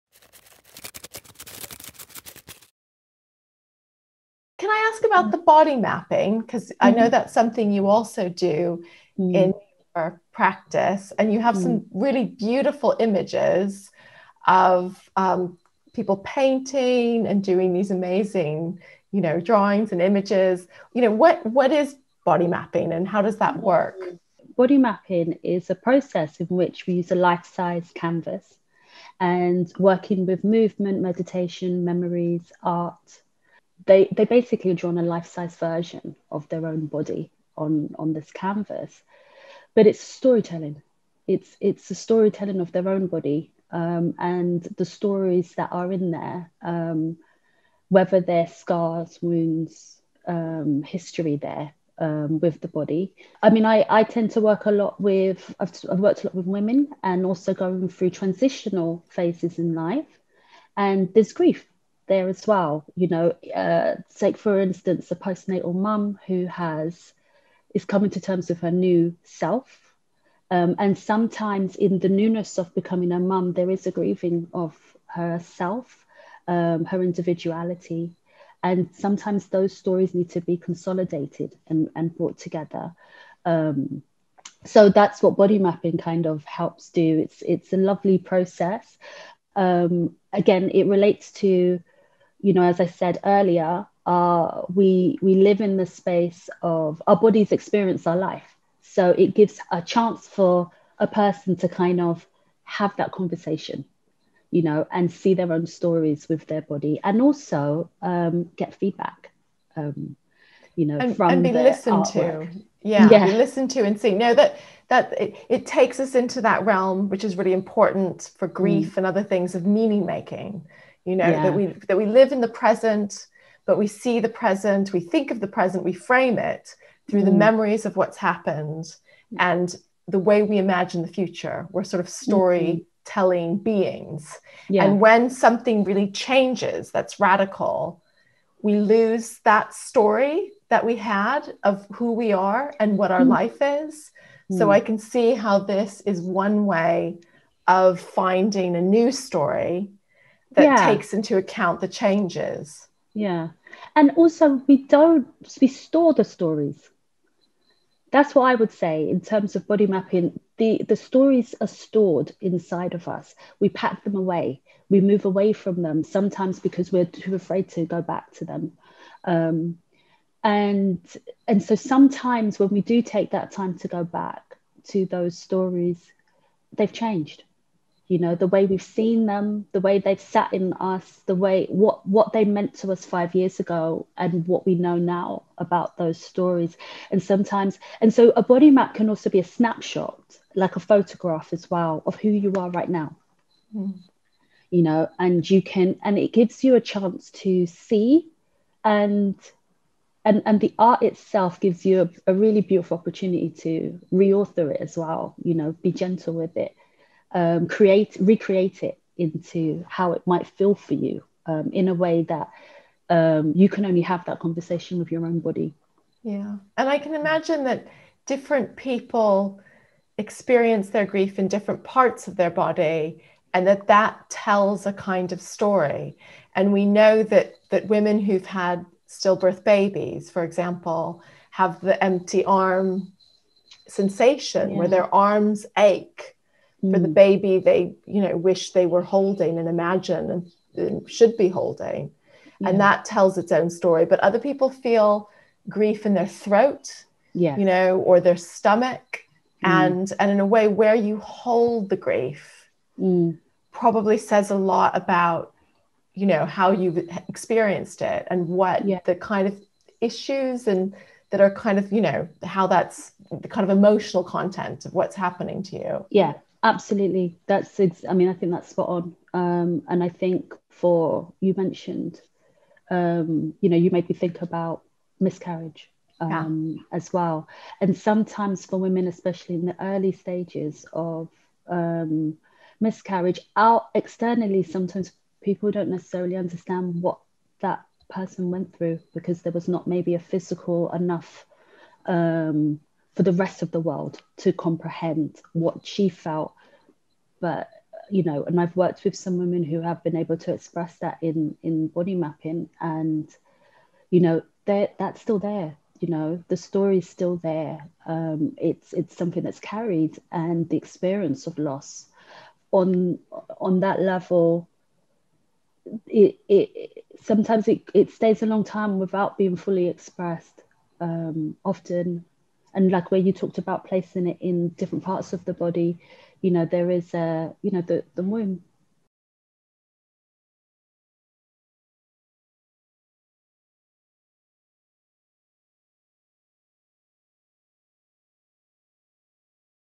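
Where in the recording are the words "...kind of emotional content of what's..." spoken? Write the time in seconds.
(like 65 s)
263 s.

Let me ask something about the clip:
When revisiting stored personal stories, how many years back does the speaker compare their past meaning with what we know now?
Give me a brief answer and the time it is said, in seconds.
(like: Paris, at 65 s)
5, at 183 s.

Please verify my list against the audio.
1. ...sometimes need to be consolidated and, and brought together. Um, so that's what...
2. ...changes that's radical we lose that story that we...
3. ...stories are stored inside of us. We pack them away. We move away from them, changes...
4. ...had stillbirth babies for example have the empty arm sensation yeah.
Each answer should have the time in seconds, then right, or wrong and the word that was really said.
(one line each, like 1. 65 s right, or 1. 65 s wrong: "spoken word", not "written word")
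1. 79 s wrong: "stories", not "sometimes"
2. 136 s right
3. 160 s wrong: "sometimes", not "changes"
4. 228 s right.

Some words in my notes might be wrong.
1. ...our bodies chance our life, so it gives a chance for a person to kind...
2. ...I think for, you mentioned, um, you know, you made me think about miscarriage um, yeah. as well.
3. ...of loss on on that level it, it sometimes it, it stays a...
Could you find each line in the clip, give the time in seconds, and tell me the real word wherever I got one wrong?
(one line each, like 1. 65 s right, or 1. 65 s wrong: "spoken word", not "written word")
1. 97 s wrong: "experience", not "chance"
2. 270 s right
3. 311 s right.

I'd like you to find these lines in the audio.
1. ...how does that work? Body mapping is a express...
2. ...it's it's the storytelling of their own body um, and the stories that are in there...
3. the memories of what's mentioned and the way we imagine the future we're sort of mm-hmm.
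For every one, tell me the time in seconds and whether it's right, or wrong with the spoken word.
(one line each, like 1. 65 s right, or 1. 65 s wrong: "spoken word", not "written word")
1. 23 s wrong: "process", not "express"
2. 41 s right
3. 127 s wrong: "happened", not "mentioned".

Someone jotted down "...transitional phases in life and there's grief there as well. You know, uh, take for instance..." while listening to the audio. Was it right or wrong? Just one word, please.
right.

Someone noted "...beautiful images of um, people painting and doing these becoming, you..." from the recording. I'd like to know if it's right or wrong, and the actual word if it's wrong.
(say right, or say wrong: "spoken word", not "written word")
wrong: "amazing", not "becoming".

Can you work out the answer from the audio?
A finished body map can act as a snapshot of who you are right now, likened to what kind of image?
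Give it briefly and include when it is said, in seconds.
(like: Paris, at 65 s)
A photograph, at 190 s.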